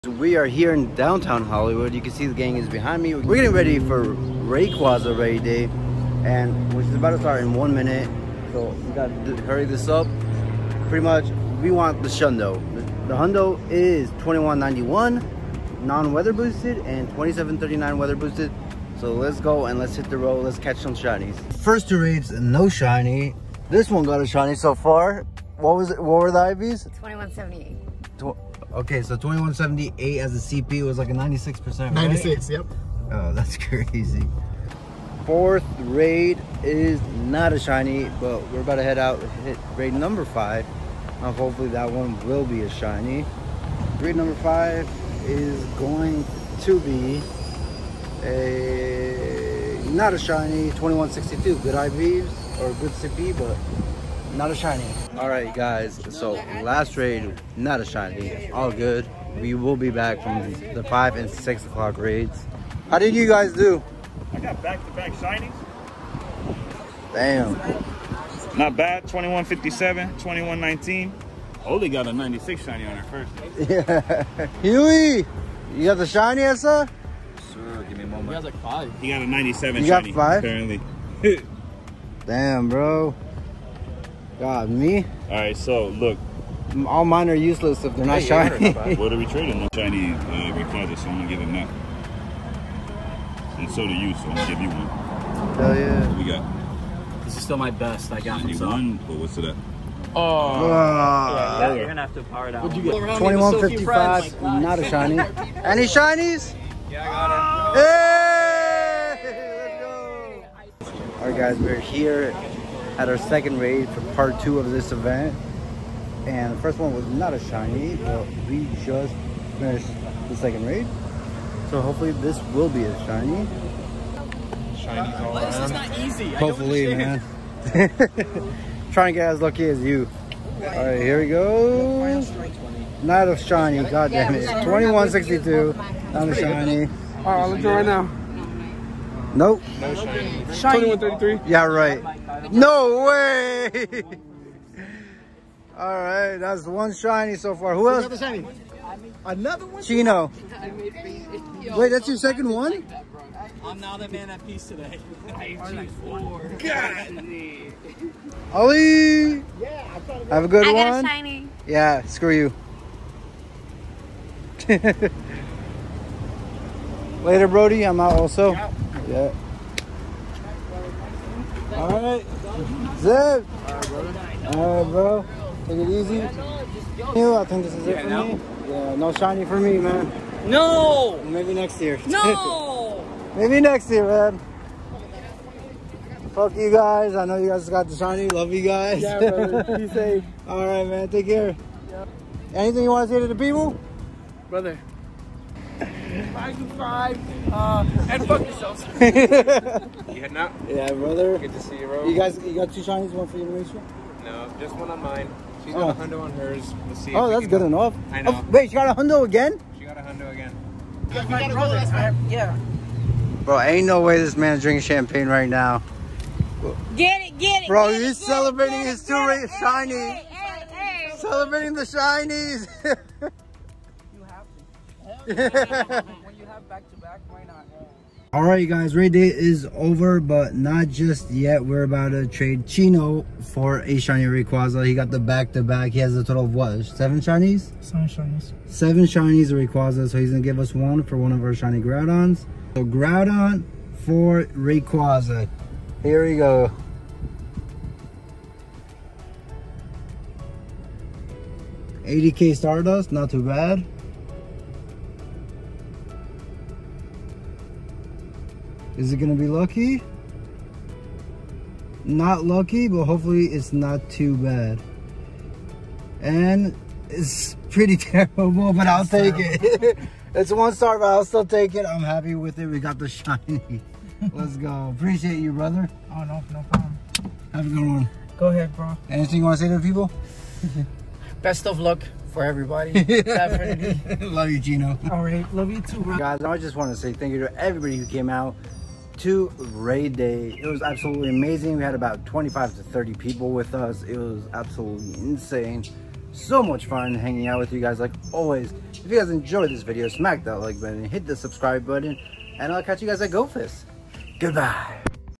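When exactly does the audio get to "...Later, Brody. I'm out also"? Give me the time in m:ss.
2:47.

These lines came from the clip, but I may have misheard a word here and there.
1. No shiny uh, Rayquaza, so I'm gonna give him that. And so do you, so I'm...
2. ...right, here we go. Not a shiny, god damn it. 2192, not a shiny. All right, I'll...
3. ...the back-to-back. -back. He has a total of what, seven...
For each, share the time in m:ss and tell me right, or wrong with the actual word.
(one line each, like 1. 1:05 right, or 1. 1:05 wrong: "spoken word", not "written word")
1. 1:29 right
2. 2:10 wrong: "2162", not "2192"
3. 3:55 right.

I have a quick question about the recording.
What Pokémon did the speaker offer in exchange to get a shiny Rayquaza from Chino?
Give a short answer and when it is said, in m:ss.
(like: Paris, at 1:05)
Groudon, at 4:02.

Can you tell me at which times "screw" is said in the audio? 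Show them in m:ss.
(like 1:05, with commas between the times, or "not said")
2:42.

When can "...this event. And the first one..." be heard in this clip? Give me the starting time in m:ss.
1:54.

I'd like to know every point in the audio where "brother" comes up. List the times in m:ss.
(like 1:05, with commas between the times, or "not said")
3:09, 3:14, 3:20, 3:31, 4:35.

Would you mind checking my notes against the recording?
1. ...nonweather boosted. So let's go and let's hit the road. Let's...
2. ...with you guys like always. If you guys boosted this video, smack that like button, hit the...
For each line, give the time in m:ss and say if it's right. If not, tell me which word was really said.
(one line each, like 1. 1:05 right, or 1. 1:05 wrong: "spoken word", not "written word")
1. 0:17 wrong: "weather", not "nonweather"
2. 4:57 wrong: "enjoyed", not "boosted".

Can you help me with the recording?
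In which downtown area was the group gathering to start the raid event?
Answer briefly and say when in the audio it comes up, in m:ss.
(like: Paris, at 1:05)
Hollywood, at 0:01.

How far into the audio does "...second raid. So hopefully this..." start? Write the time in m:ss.
2:00.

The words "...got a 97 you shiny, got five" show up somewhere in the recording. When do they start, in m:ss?
1:19.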